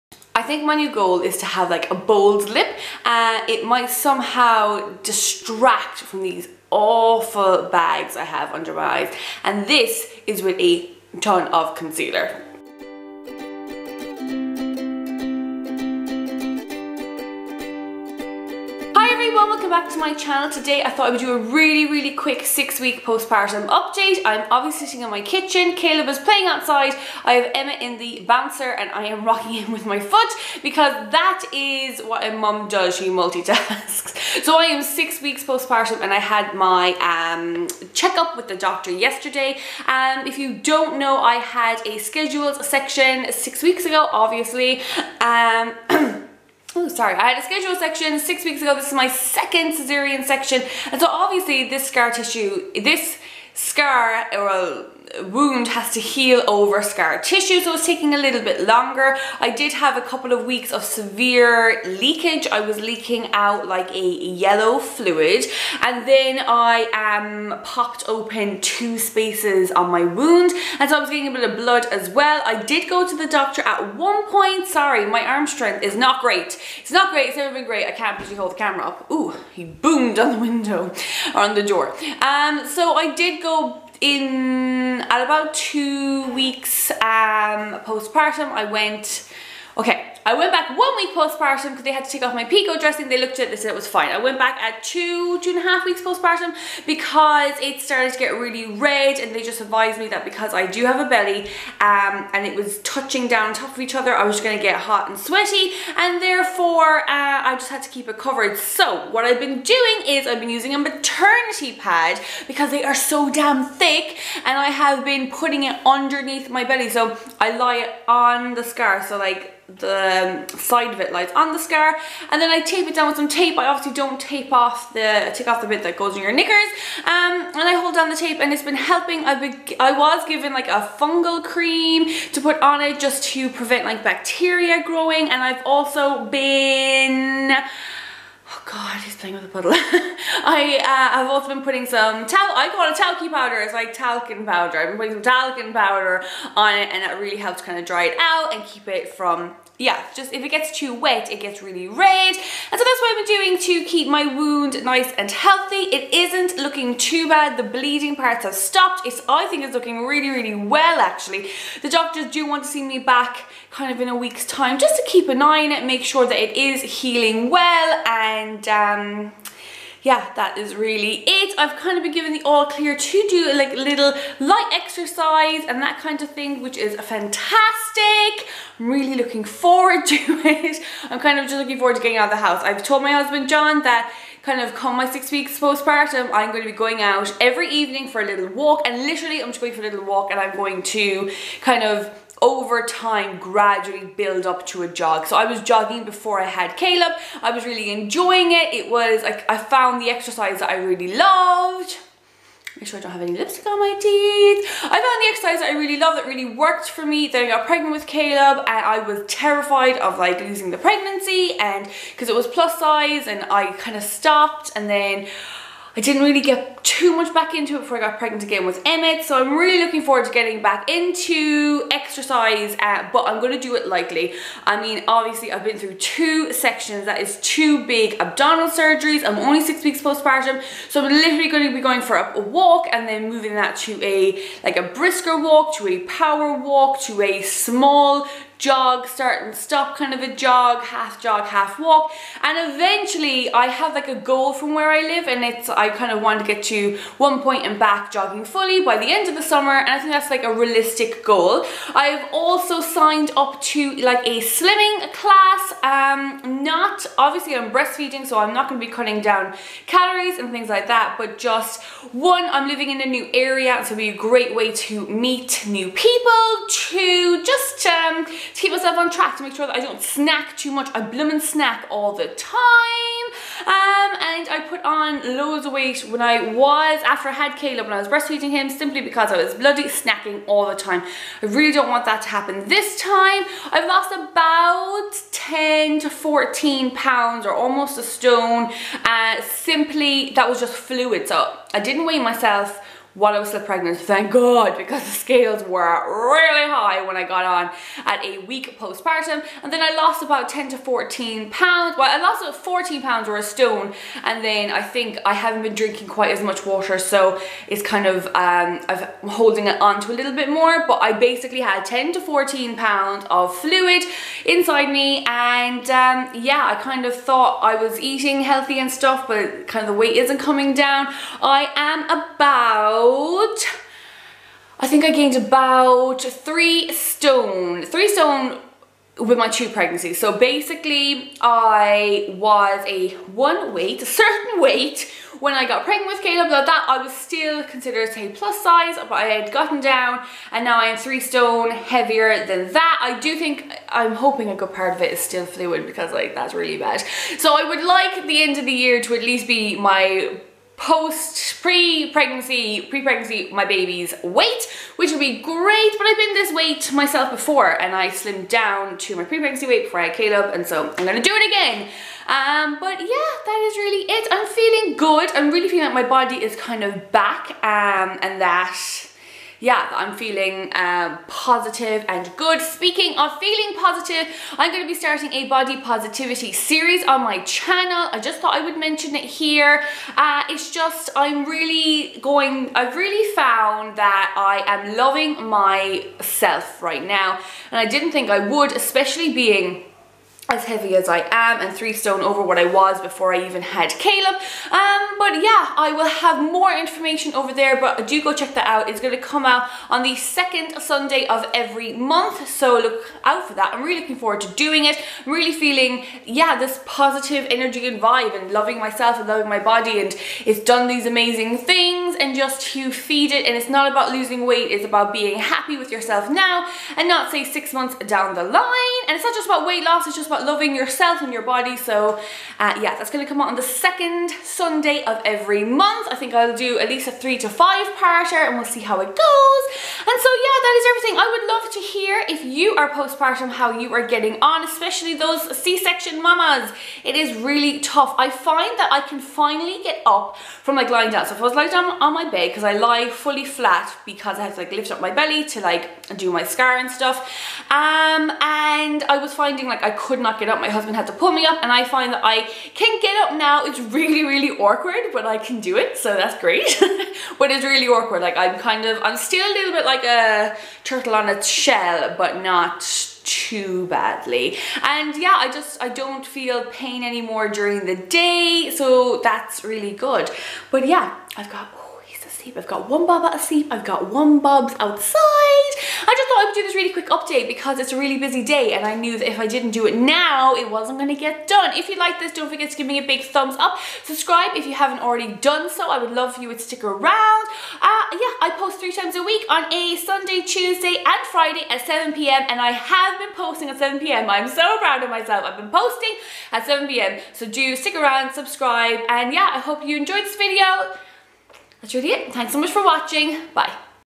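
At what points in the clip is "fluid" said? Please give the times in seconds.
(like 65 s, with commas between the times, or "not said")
64 s, 290 s, 313 s, 345 s.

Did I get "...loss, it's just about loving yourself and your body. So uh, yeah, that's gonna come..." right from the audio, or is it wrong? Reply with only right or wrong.
right.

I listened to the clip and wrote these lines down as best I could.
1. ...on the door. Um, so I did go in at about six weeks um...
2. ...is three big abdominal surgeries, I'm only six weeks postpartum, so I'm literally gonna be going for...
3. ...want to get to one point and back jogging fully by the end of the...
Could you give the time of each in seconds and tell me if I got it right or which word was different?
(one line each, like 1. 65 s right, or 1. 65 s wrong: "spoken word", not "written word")
1. 81 s wrong: "two", not "six"
2. 227 s wrong: "two", not "three"
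3. 246 s right.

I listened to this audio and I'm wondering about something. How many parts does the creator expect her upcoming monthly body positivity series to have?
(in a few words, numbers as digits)
3 to 5.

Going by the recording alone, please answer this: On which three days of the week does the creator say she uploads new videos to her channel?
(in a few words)
Sunday, Tuesday, and Friday.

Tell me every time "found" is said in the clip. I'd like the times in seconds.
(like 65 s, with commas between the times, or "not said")
199 s, 204 s, 383 s.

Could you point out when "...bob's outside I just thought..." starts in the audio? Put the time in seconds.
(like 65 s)
474 s.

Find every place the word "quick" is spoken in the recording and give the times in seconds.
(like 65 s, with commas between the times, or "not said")
22 s, 476 s.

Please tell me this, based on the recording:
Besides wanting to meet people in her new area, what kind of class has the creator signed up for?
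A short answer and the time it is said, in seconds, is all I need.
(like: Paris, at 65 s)
Slimming class, at 254 s.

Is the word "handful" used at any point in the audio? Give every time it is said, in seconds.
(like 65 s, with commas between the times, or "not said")
not said.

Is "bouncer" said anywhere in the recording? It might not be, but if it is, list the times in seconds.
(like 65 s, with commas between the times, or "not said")
28 s.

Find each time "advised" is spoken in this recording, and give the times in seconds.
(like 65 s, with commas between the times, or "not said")
99 s.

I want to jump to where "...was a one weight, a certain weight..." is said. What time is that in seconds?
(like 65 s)
332 s.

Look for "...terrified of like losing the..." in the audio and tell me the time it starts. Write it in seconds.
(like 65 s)
209 s.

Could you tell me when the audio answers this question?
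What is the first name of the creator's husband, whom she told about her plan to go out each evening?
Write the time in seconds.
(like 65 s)
183 s.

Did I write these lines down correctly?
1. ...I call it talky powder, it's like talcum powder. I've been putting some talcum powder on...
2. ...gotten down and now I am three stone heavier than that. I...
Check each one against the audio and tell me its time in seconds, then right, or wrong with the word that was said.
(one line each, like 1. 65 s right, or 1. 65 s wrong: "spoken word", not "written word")
1. 142 s right
2. 339 s right.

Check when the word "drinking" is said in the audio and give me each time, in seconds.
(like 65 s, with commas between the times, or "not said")
305 s.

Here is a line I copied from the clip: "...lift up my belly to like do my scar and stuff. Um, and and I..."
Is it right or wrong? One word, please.
right.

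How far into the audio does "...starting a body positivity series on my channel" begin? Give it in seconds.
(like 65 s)
374 s.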